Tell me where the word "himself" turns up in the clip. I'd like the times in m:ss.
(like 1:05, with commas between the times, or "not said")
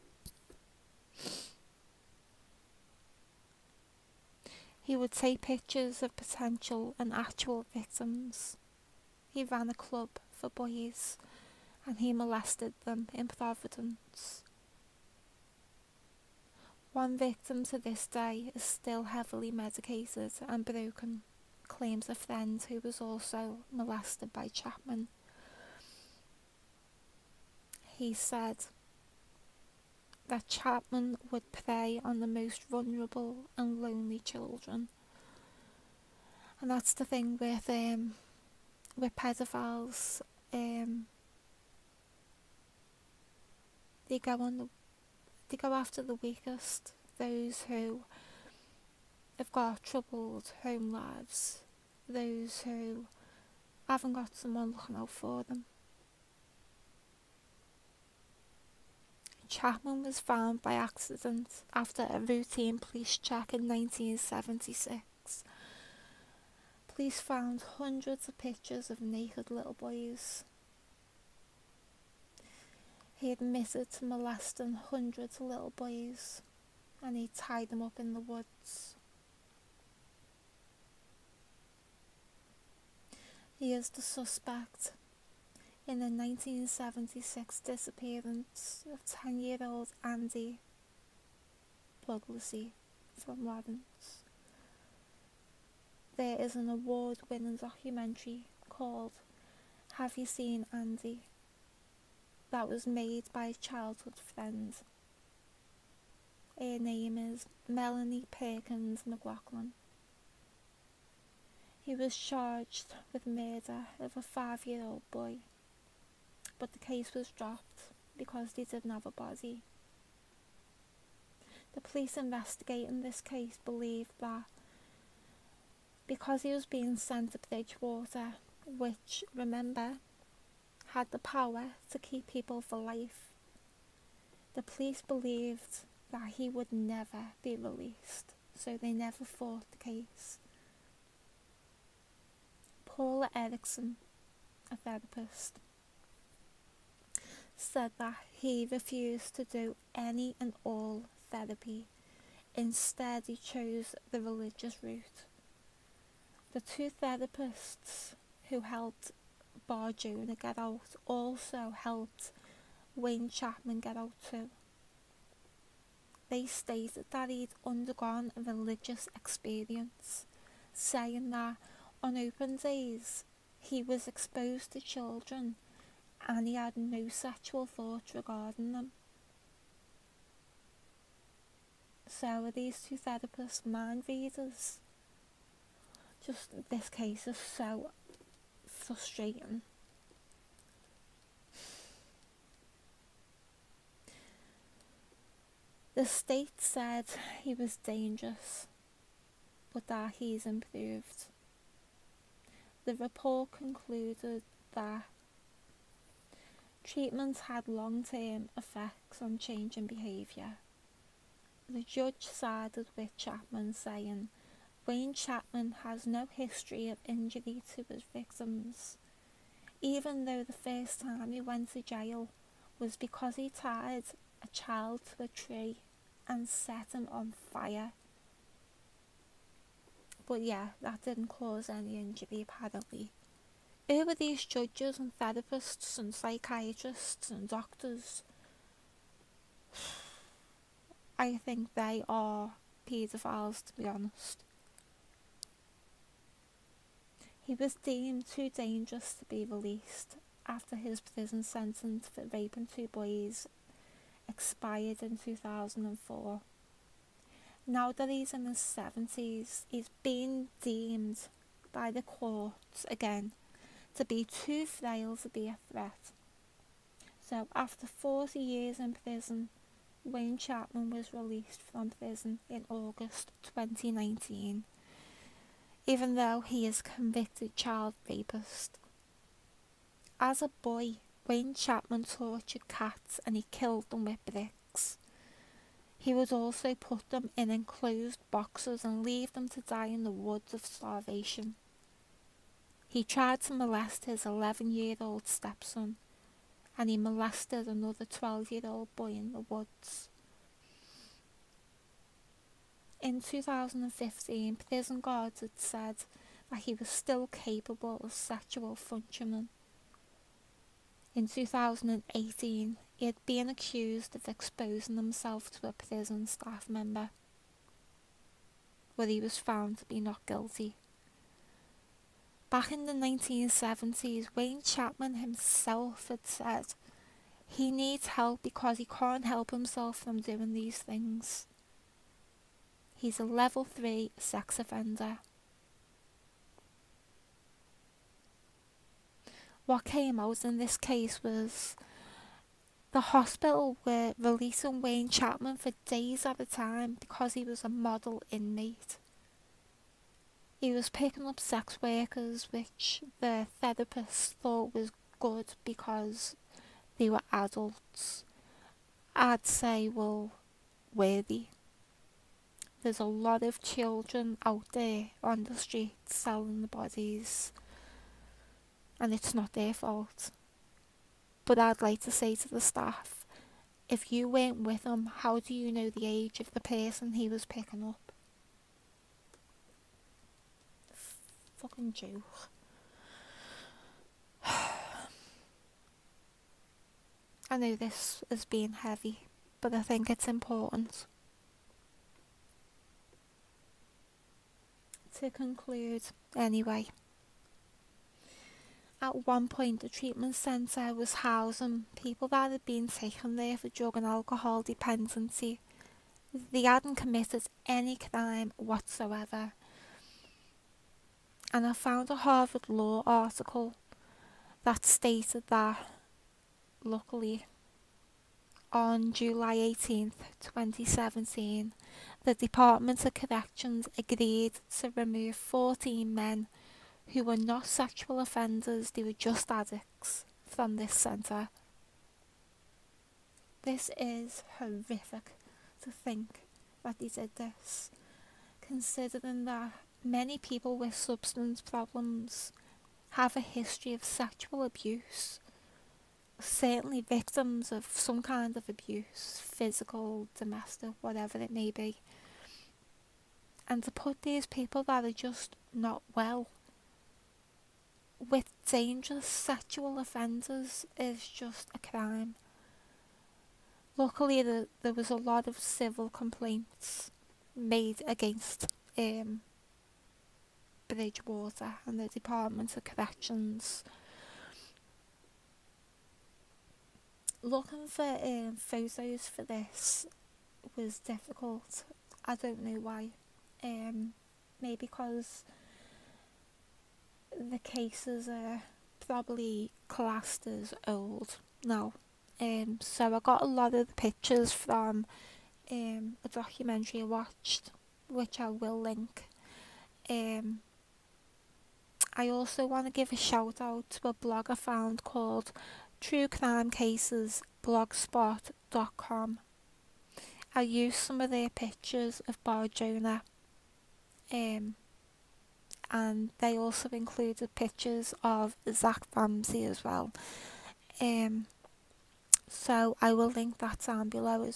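5:14, 5:25, 5:29.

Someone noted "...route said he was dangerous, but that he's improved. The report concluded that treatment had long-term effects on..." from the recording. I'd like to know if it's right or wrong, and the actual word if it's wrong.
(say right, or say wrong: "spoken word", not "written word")
wrong: "state", not "route".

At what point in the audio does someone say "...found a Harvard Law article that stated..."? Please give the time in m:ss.
6:51.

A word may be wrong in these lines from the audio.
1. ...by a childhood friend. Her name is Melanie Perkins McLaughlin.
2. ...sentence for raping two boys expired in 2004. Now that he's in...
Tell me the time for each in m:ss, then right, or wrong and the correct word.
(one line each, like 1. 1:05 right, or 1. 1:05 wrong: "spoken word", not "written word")
1. 1:43 right
2. 4:11 right.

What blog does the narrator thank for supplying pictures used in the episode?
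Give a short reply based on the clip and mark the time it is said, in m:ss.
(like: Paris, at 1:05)
True Crime Cases, at 8:25.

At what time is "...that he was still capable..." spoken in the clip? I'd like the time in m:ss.
5:06.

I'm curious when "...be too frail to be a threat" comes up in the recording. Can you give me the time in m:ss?
4:24.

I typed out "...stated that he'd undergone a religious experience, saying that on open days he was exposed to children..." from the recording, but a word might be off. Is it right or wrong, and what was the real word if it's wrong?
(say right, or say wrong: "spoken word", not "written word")
right.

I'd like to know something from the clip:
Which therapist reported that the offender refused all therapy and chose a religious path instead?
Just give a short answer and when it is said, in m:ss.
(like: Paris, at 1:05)
Paula Erickson, at 2:22.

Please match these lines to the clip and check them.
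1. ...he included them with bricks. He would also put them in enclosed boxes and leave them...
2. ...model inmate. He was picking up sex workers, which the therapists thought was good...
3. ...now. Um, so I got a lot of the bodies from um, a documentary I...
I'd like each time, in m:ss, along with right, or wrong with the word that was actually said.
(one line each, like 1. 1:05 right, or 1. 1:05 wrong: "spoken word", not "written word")
1. 4:43 wrong: "killed", not "included"
2. 5:47 right
3. 8:11 wrong: "pictures", not "bodies".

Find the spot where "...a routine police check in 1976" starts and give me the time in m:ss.
1:02.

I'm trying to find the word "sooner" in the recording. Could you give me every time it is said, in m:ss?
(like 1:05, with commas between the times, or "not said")
not said.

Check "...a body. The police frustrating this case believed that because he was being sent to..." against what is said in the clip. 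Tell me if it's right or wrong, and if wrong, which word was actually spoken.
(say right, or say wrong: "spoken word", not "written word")
wrong: "investigating", not "frustrating".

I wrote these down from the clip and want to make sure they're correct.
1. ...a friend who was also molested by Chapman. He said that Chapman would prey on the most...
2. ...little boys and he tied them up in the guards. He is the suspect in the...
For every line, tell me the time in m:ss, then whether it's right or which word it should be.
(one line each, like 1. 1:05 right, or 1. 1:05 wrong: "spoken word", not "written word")
1. 0:22 right
2. 1:15 wrong: "woods", not "guards".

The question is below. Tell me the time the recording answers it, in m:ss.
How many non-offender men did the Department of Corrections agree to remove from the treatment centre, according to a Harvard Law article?
7:05.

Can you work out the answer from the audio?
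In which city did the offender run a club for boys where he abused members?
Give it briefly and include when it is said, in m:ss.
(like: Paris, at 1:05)
Providence, at 0:13.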